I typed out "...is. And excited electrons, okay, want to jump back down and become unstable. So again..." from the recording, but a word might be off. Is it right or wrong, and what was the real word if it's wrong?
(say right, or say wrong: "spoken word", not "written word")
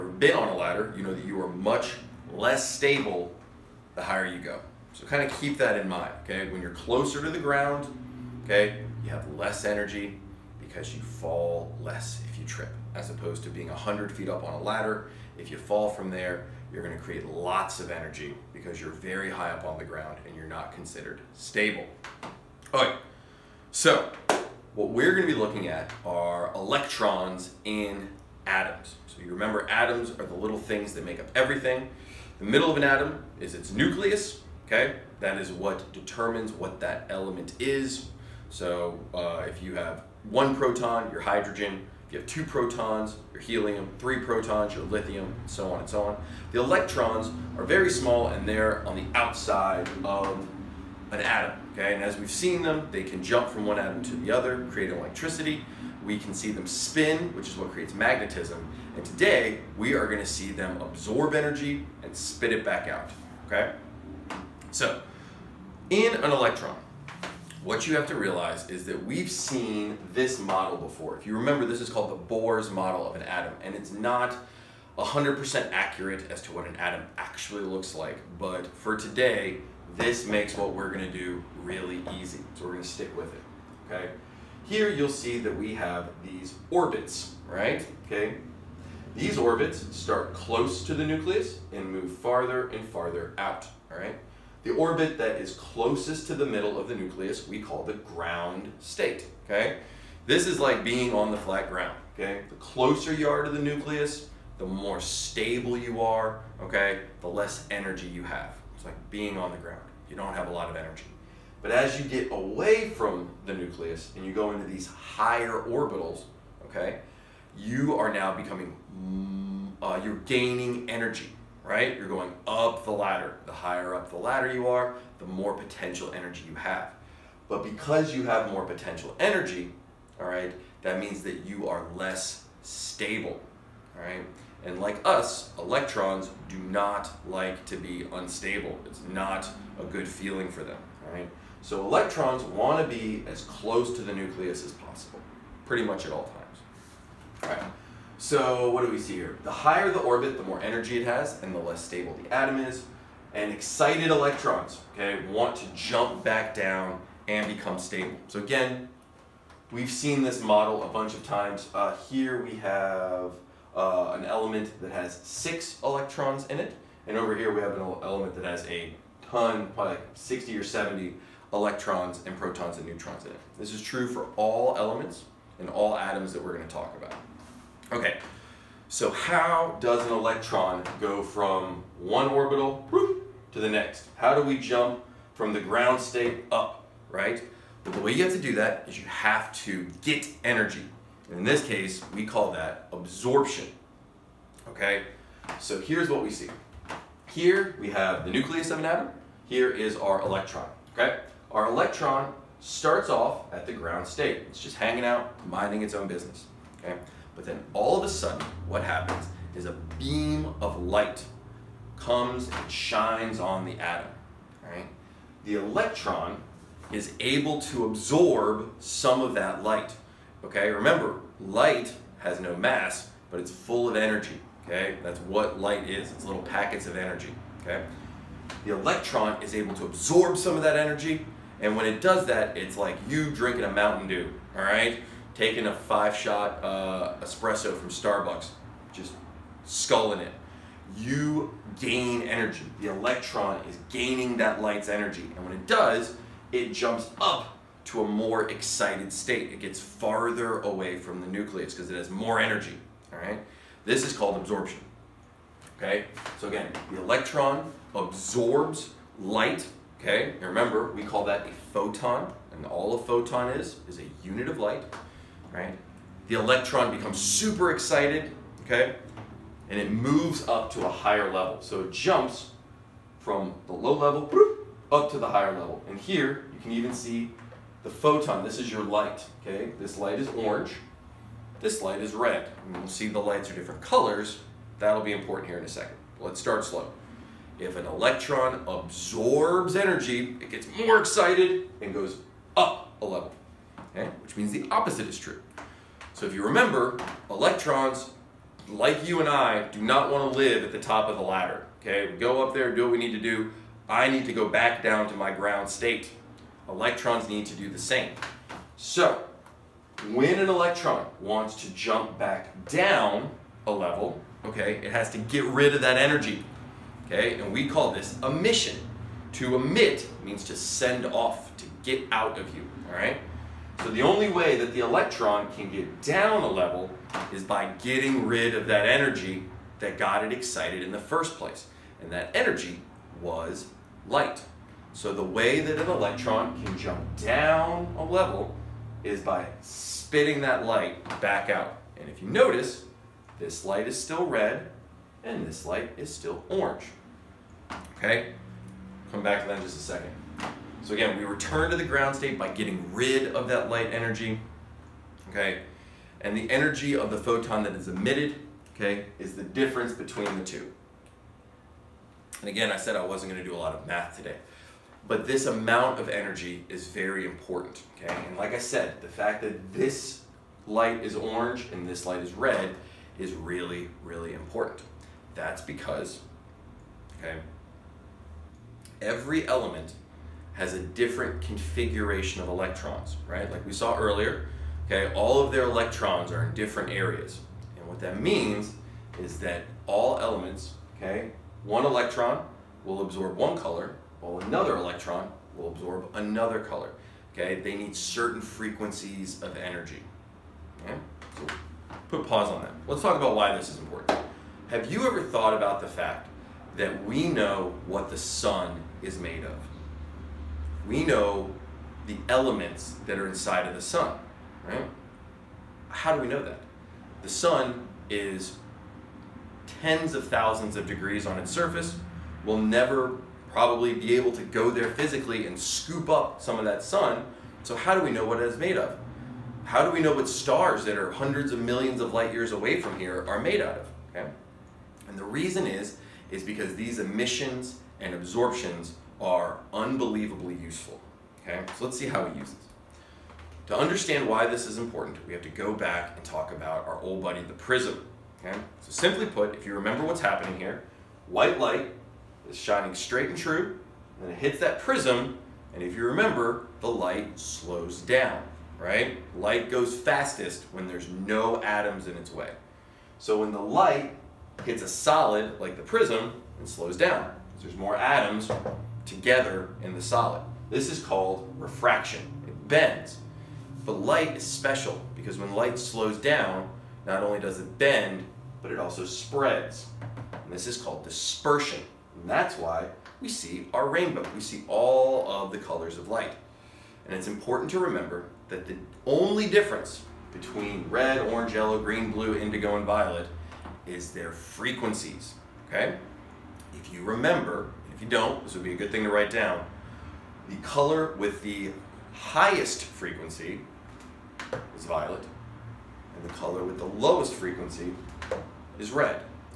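wrong: "stable", not "unstable".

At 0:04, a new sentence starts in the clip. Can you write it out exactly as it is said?
So kind of keep that in mind, okay?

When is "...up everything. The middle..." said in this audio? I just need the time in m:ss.
0:31.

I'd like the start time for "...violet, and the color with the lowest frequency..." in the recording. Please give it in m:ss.
8:24.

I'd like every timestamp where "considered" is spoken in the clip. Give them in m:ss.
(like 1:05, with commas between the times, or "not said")
0:20.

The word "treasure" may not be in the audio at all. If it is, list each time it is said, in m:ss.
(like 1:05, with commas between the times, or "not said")
not said.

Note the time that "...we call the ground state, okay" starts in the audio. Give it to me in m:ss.
1:37.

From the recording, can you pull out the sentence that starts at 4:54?
which means the opposite is true.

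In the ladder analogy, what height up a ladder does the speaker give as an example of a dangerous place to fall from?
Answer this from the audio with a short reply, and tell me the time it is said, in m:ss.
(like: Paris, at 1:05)
100 feet, at 0:13.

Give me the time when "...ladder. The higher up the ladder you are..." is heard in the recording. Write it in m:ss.
2:02.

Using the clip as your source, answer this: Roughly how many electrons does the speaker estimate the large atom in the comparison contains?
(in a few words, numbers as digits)
60 or 70.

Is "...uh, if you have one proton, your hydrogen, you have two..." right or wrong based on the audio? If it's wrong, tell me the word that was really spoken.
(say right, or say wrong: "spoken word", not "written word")
right.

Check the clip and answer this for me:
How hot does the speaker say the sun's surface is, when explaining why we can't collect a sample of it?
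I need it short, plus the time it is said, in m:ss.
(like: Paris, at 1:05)
tens of thousands of degrees, at 6:59.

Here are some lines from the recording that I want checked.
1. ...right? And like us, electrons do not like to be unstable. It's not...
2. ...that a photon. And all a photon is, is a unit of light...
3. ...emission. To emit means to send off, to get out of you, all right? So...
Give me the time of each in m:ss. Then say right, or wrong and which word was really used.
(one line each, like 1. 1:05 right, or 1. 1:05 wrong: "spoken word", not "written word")
1. 2:14 right
2. 4:21 right
3. 5:18 right.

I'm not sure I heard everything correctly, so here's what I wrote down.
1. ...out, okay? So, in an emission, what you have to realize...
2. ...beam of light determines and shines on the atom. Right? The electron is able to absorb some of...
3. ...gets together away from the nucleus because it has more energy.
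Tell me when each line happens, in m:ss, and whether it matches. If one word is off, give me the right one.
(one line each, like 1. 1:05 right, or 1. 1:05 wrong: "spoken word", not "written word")
1. 1:02 wrong: "electron", not "emission"
2. 3:29 wrong: "comes", not "determines"
3. 4:09 wrong: "farther", not "together".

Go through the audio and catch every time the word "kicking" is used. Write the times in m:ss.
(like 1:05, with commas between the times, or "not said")
not said.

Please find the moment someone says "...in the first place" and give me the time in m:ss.
5:30.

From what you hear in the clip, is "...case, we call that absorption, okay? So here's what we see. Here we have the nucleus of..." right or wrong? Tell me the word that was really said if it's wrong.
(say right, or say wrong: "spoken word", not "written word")
right.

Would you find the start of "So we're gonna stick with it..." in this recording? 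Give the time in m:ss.
1:22.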